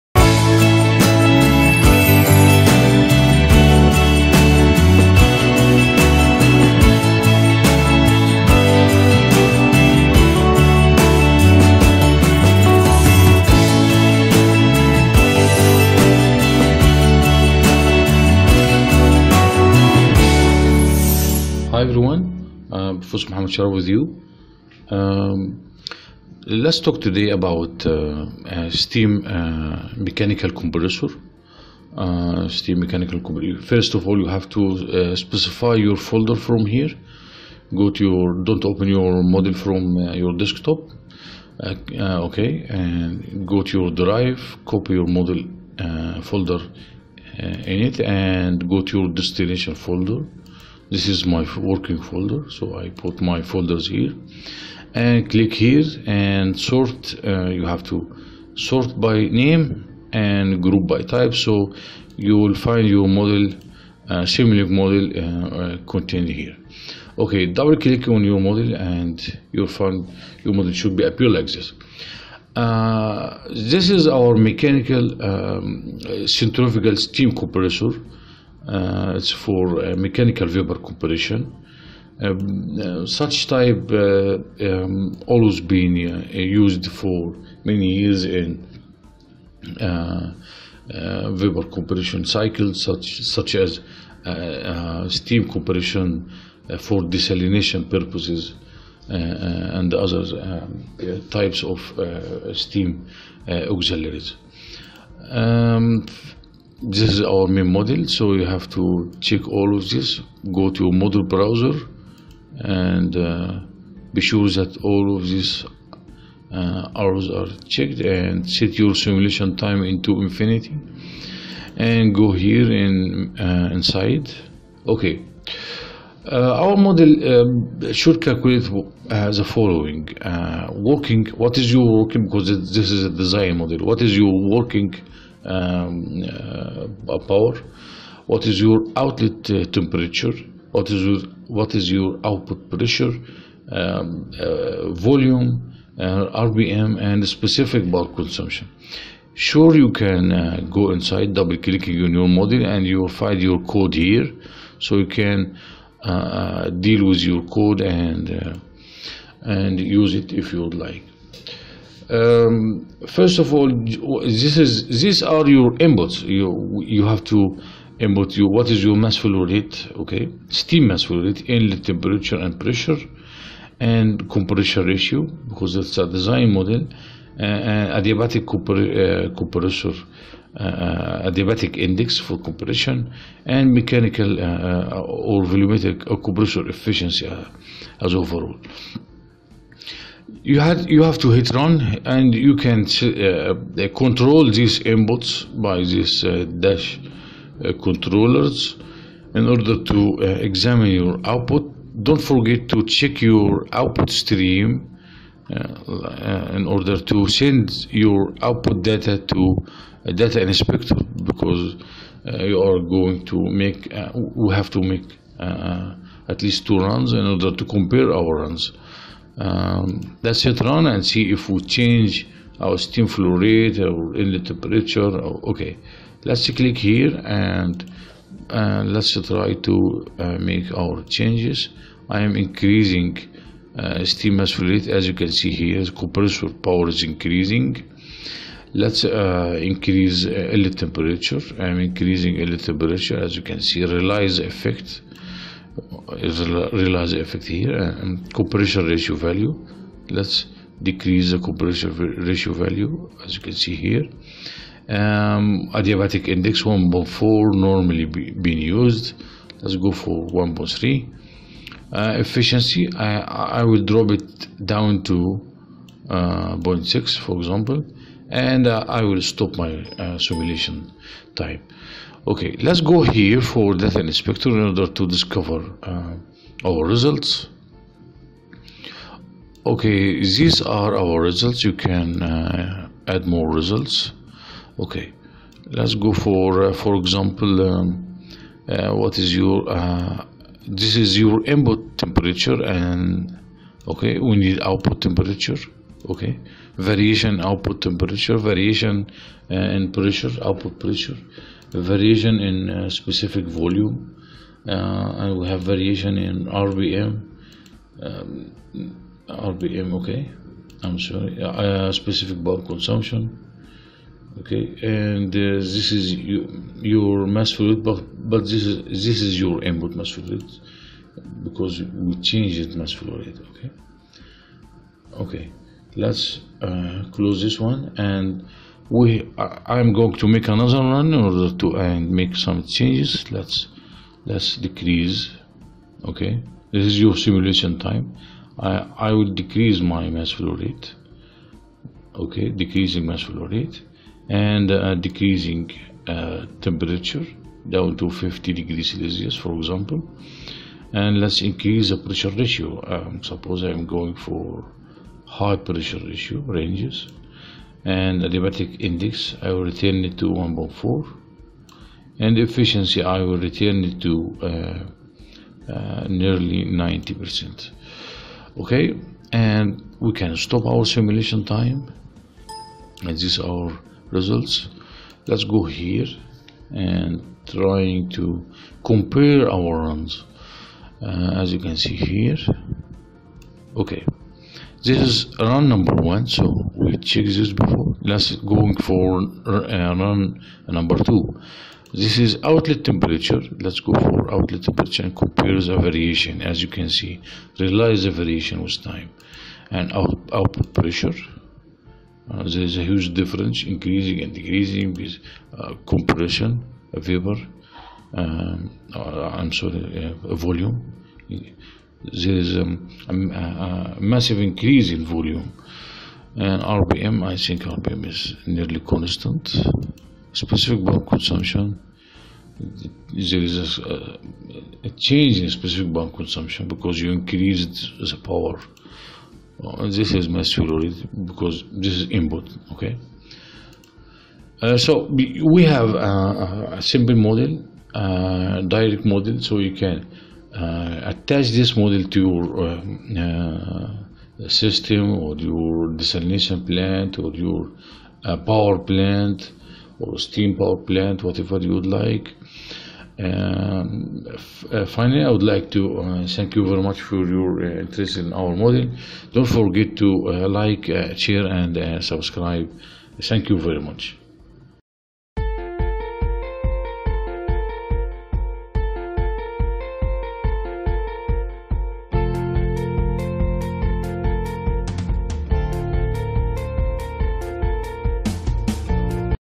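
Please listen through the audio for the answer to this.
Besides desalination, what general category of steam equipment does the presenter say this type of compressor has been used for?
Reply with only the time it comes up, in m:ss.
1:43.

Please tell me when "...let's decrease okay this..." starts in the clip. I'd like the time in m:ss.
5:34.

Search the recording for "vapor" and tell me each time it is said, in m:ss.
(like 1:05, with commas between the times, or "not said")
1:20, 1:31, 6:46.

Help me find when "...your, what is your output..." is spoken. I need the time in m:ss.
2:21.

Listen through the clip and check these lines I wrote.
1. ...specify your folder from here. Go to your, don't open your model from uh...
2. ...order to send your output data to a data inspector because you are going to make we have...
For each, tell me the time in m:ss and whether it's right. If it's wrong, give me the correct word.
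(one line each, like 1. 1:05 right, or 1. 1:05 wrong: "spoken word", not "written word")
1. 0:35 right
2. 3:26 right.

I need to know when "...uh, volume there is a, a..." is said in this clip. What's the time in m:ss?
6:50.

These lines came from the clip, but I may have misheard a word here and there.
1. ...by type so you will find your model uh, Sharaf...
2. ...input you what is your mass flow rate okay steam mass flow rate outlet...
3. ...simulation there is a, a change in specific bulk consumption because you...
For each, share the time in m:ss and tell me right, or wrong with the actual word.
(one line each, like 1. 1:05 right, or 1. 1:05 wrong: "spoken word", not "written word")
1. 1:00 wrong: "Simulink", not "Sharaf"
2. 2:47 wrong: "inlet", not "outlet"
3. 7:01 wrong: "consumption", not "simulation".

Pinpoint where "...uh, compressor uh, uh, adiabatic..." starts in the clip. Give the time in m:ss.
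2:59.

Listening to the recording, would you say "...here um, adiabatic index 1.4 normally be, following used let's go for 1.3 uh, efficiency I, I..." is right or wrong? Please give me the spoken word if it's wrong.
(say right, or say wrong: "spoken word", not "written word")
wrong: "being", not "following".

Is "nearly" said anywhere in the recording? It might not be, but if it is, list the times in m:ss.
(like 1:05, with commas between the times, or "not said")
6:06, 6:58.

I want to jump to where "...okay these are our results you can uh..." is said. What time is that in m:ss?
4:39.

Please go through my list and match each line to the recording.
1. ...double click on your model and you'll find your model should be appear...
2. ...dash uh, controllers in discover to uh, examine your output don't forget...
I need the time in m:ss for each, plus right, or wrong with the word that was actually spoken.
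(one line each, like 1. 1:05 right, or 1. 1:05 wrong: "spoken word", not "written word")
1. 1:07 right
2. 3:16 wrong: "order", not "discover".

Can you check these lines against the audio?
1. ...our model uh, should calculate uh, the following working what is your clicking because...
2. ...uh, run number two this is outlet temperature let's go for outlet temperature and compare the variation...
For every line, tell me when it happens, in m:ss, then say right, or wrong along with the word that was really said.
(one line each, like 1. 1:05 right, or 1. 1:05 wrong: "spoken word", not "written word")
1. 2:06 wrong: "working", not "clicking"
2. 6:29 right.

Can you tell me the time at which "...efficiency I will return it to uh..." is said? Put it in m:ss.
6:02.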